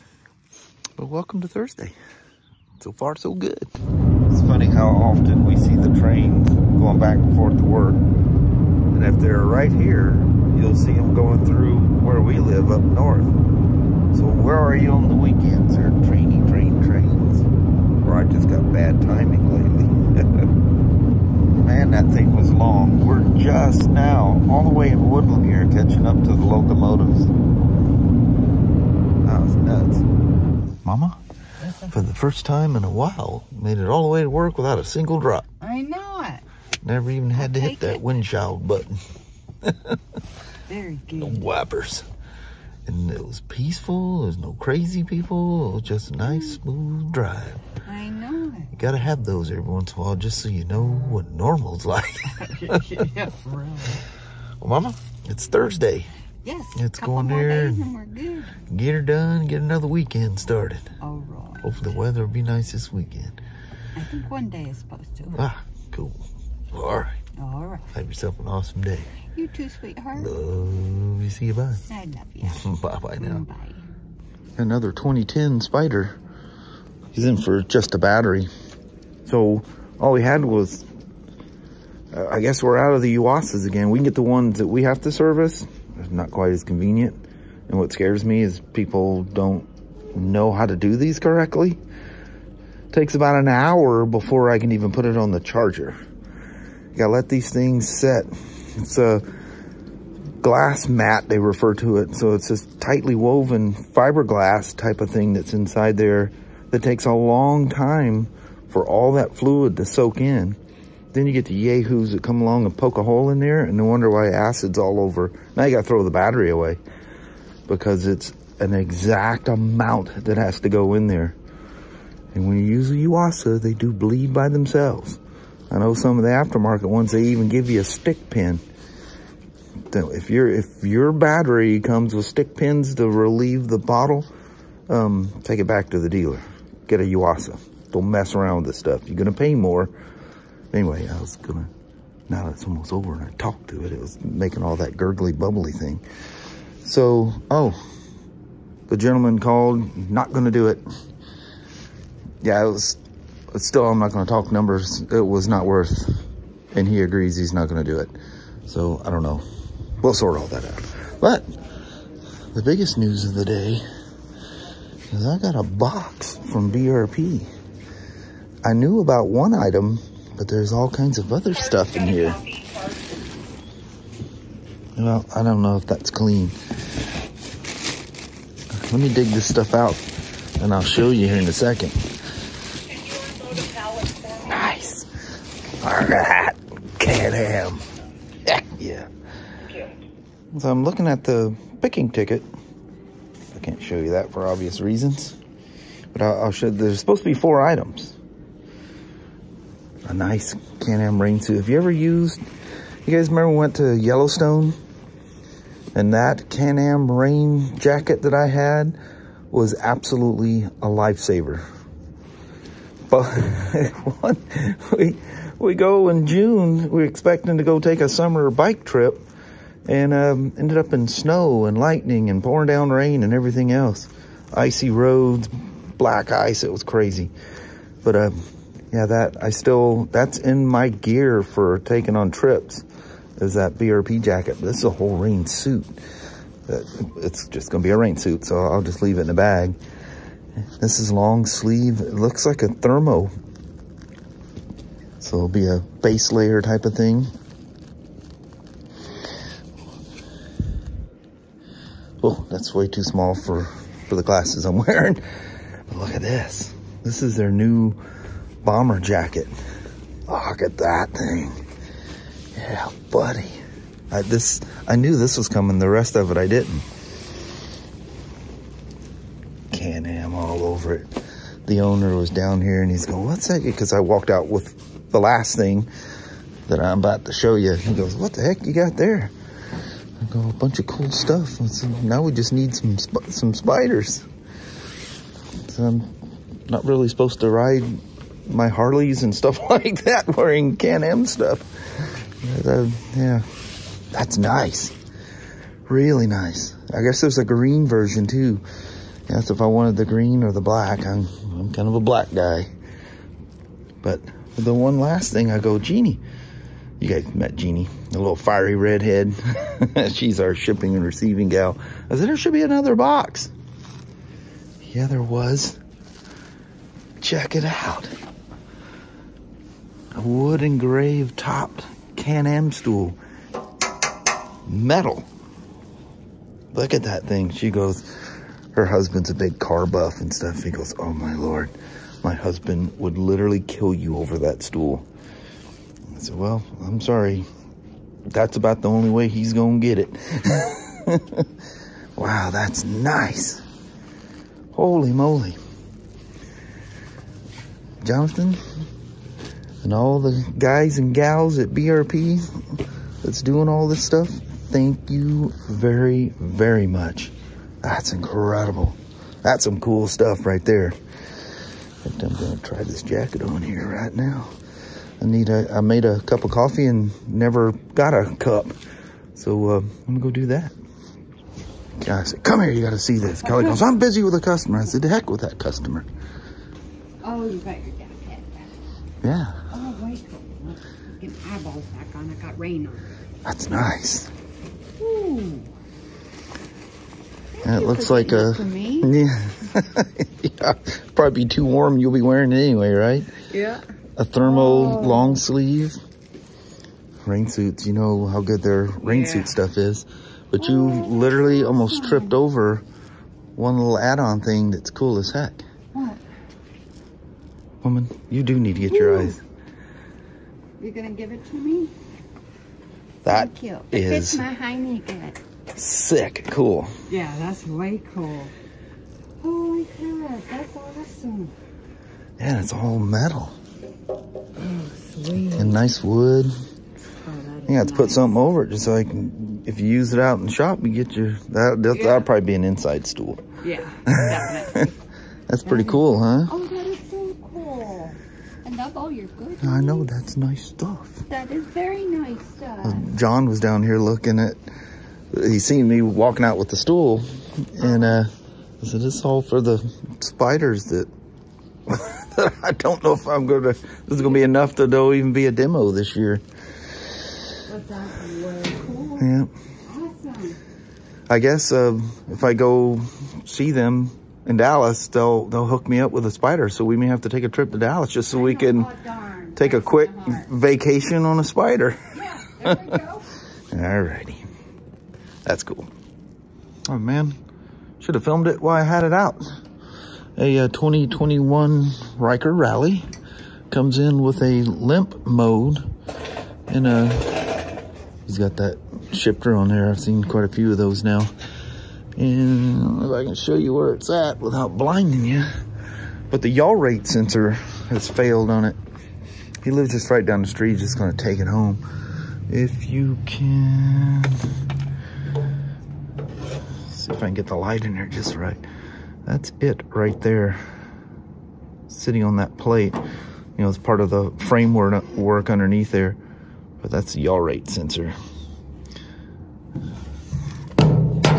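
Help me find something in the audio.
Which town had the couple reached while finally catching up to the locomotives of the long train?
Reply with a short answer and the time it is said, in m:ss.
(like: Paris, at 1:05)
Woodland, at 0:25.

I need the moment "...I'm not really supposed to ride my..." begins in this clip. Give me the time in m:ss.
4:45.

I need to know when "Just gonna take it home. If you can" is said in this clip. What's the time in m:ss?
8:20.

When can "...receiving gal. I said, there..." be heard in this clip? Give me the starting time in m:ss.
5:11.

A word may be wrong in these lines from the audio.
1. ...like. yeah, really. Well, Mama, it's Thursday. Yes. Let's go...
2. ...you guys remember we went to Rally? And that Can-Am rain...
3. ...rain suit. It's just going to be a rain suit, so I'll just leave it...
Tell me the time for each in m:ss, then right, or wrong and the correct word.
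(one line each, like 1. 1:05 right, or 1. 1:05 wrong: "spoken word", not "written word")
1. 0:51 right
2. 3:23 wrong: "Yellowstone", not "Rally"
3. 3:55 right.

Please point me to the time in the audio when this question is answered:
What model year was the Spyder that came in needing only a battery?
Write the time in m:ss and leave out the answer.
1:14.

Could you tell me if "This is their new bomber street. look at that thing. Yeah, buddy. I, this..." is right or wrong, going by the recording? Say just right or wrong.
wrong.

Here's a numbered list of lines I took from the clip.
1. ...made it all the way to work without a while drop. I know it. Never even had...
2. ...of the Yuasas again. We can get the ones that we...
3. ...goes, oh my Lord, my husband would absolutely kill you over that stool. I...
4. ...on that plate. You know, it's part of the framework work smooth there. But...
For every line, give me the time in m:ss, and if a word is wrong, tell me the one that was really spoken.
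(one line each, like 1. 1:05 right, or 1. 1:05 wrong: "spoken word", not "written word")
1. 0:33 wrong: "single", not "while"
2. 1:22 right
3. 5:30 wrong: "literally", not "absolutely"
4. 8:32 wrong: "underneath", not "smooth".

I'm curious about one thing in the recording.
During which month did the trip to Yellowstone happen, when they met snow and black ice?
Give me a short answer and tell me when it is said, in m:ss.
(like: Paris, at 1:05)
June, at 3:36.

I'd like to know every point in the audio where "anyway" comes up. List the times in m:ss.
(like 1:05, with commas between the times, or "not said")
2:20, 6:32.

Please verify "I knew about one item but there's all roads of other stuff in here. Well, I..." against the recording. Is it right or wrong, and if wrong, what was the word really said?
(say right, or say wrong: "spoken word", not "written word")
wrong: "kinds", not "roads".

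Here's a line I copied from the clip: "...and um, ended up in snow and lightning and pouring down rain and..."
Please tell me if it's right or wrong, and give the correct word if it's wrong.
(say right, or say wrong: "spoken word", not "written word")
right.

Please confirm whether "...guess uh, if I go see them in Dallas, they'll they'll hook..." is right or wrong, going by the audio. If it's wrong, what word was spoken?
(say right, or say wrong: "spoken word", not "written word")
right.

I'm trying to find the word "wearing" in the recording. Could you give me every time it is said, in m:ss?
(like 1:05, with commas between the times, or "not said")
4:14, 4:50, 6:32.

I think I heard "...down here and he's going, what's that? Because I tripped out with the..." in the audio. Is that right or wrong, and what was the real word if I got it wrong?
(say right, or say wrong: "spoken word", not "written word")
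wrong: "walked", not "tripped".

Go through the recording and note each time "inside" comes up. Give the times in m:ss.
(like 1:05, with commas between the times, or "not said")
1:45, 7:12.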